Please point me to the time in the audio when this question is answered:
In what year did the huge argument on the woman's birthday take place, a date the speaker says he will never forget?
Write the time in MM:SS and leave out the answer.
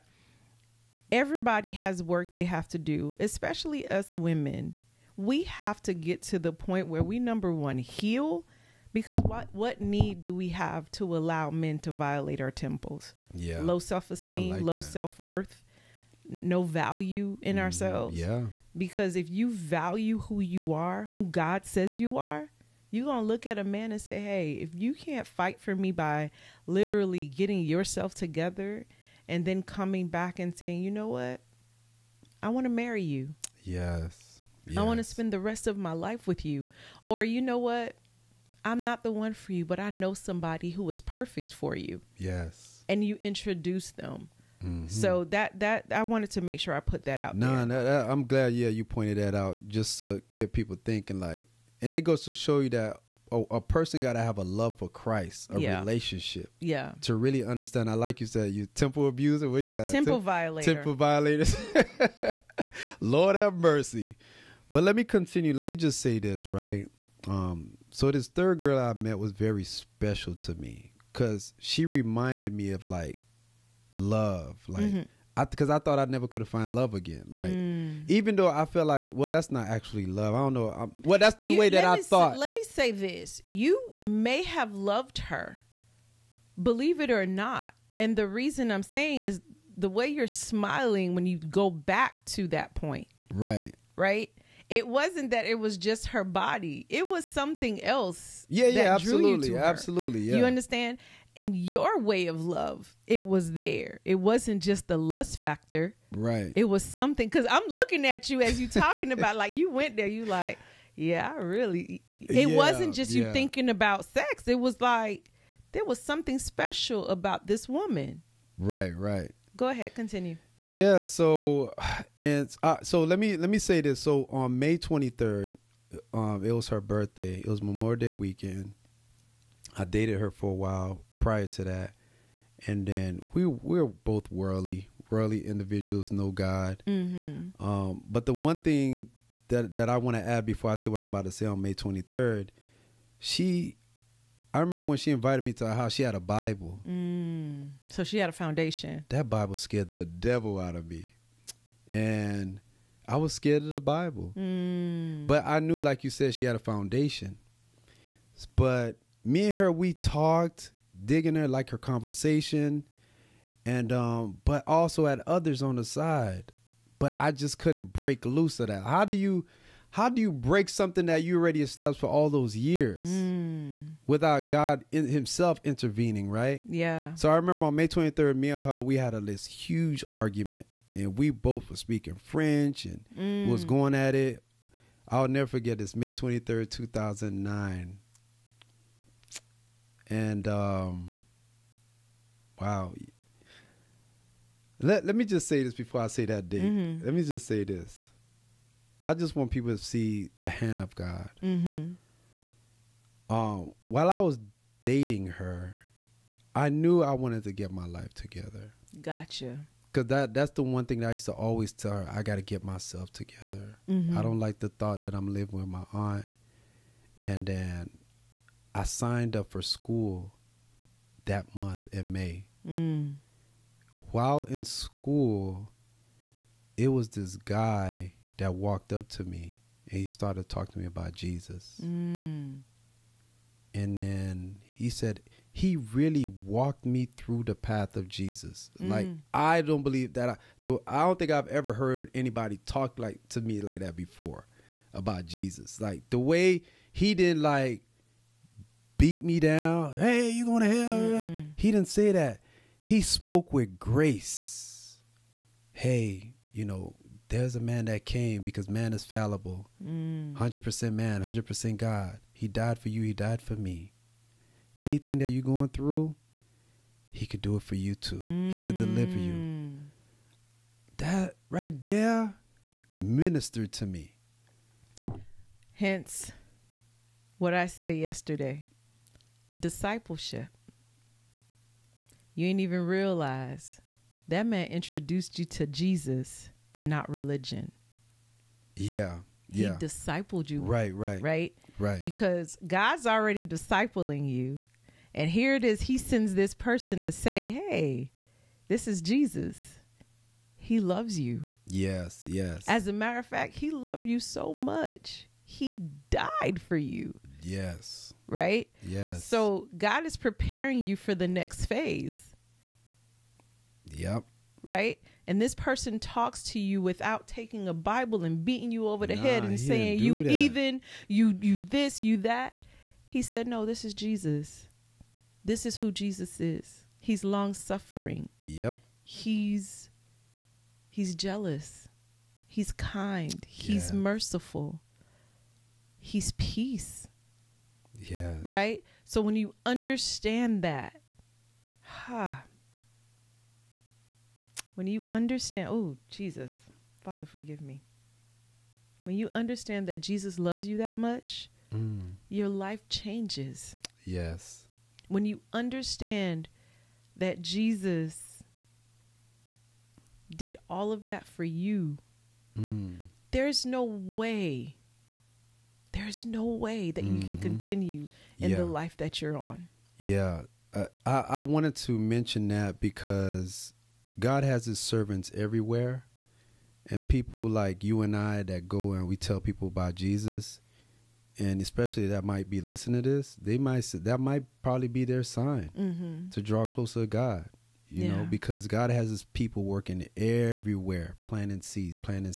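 03:06.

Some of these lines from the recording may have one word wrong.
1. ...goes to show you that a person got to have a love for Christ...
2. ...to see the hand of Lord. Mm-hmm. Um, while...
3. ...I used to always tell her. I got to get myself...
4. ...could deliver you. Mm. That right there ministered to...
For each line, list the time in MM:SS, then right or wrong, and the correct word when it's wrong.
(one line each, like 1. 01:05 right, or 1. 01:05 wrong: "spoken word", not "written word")
1. 00:52 right
2. 03:19 wrong: "God", not "Lord"
3. 03:31 right
4. 04:28 right.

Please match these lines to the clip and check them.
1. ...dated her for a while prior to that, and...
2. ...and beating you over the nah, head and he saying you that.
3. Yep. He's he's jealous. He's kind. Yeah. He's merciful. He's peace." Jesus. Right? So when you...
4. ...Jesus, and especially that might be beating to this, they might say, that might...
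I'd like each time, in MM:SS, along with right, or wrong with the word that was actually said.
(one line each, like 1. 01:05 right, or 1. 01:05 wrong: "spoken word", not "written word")
1. 02:09 right
2. 05:18 right
3. 05:28 wrong: "Yes", not "Jesus"
4. 06:19 wrong: "listening", not "beating".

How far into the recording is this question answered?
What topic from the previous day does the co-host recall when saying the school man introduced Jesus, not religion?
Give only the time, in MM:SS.
04:39.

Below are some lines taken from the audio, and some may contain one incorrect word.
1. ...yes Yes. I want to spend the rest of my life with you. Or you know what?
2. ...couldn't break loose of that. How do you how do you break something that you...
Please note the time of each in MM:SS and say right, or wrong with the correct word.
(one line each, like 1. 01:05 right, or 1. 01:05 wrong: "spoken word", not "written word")
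1. 00:33 right
2. 02:47 right.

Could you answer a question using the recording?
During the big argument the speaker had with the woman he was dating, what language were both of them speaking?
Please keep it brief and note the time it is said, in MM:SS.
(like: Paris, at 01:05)
French, at 03:02.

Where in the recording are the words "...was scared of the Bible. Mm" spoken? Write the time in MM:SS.
02:33.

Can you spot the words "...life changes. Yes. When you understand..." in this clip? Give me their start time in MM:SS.
05:52.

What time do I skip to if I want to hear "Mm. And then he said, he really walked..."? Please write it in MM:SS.
03:51.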